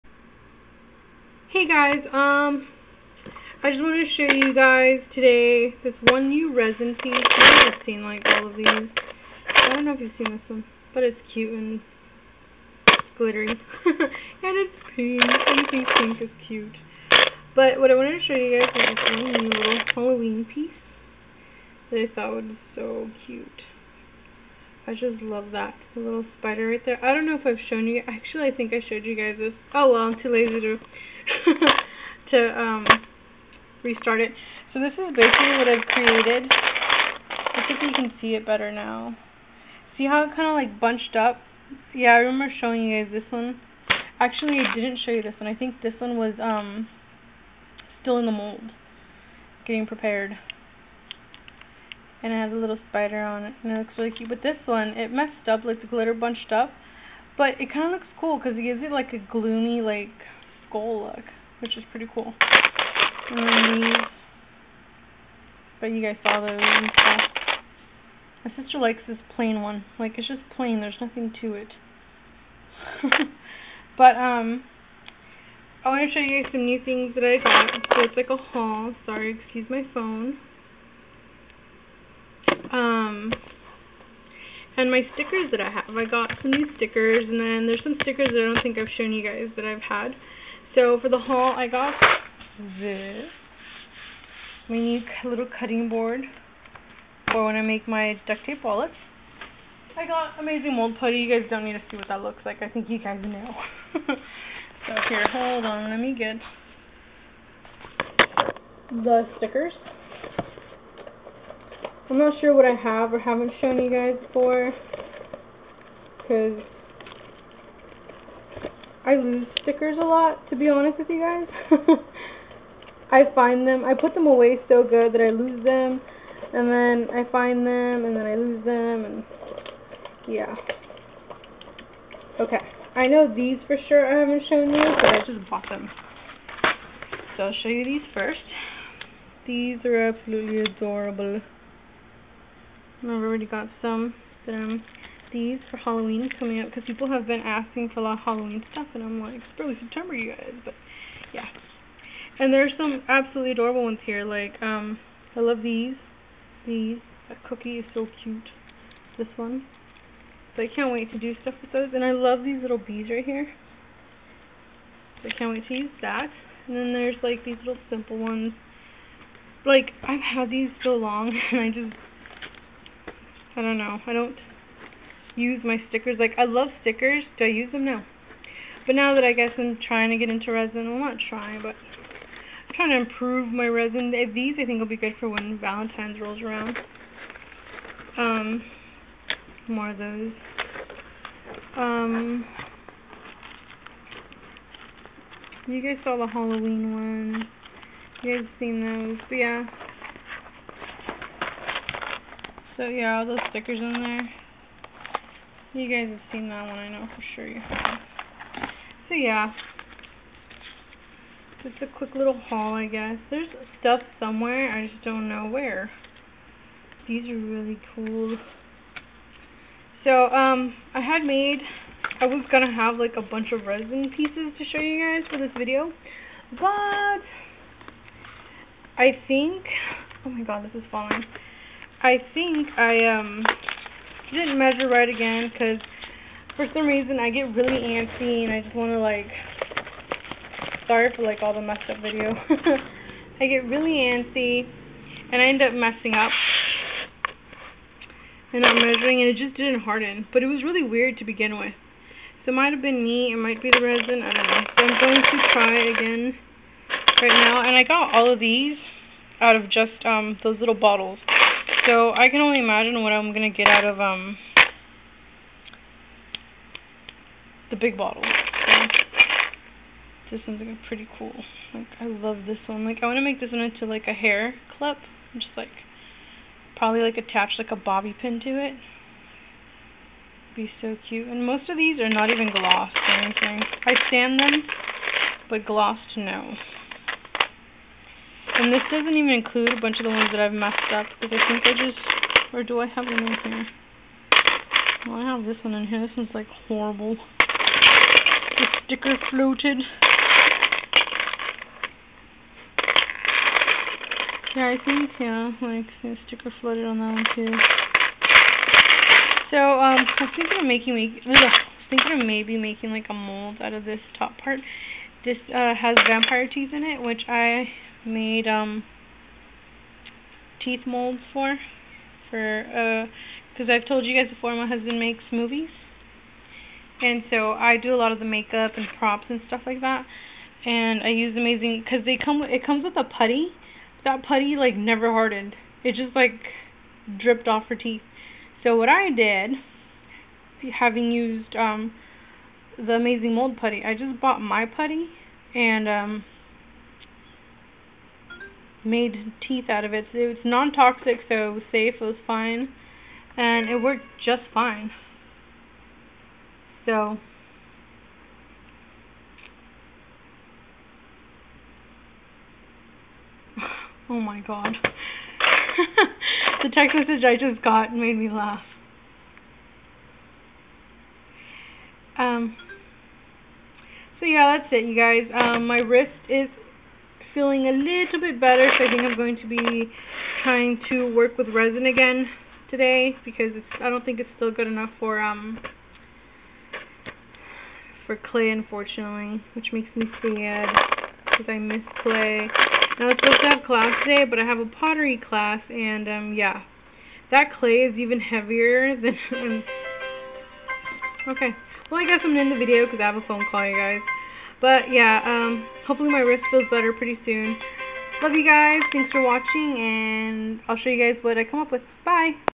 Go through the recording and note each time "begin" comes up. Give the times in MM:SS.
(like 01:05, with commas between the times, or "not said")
04:11.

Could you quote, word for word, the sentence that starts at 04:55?
Well, I have this one in here.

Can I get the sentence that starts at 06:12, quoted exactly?
Um so yeah, that's it you guys.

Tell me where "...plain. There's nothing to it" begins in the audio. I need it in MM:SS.
01:10.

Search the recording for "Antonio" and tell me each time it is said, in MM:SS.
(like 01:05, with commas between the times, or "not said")
not said.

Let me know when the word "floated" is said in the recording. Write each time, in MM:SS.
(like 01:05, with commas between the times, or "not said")
04:59, 05:06.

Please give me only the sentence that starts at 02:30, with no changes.
But yeah, and there's some absolutely adorable ones here.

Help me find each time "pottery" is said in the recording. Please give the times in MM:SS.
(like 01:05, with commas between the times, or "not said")
06:34.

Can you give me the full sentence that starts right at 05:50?
So it's non-toxic, so it was safe, it was fine, and it worked just fine.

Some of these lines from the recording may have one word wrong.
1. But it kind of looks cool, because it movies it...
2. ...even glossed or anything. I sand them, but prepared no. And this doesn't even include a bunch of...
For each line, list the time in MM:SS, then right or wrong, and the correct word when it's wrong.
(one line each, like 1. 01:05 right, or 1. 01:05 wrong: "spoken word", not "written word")
1. 00:57 wrong: "gives", not "movies"
2. 04:42 wrong: "glossed", not "prepared".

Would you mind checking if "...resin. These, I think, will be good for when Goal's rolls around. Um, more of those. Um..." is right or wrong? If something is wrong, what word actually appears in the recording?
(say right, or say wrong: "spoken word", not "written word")
wrong: "Valentine", not "Goal".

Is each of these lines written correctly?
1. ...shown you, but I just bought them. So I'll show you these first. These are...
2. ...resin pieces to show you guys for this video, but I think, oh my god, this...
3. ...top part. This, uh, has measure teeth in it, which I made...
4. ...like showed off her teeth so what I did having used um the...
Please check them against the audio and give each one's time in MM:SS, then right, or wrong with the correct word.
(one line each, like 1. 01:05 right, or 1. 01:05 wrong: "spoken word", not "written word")
1. 02:14 right
2. 03:43 right
3. 05:14 wrong: "vampire", not "measure"
4. 05:36 wrong: "dripped", not "showed".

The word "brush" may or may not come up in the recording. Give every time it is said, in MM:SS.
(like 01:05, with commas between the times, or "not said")
not said.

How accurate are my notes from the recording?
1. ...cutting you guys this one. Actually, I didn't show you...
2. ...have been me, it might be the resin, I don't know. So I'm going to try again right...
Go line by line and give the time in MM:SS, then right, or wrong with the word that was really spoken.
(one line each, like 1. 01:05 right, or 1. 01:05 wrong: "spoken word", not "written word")
1. 00:42 wrong: "showing", not "cutting"
2. 04:12 right.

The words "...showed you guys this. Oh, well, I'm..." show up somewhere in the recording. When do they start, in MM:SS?
00:28.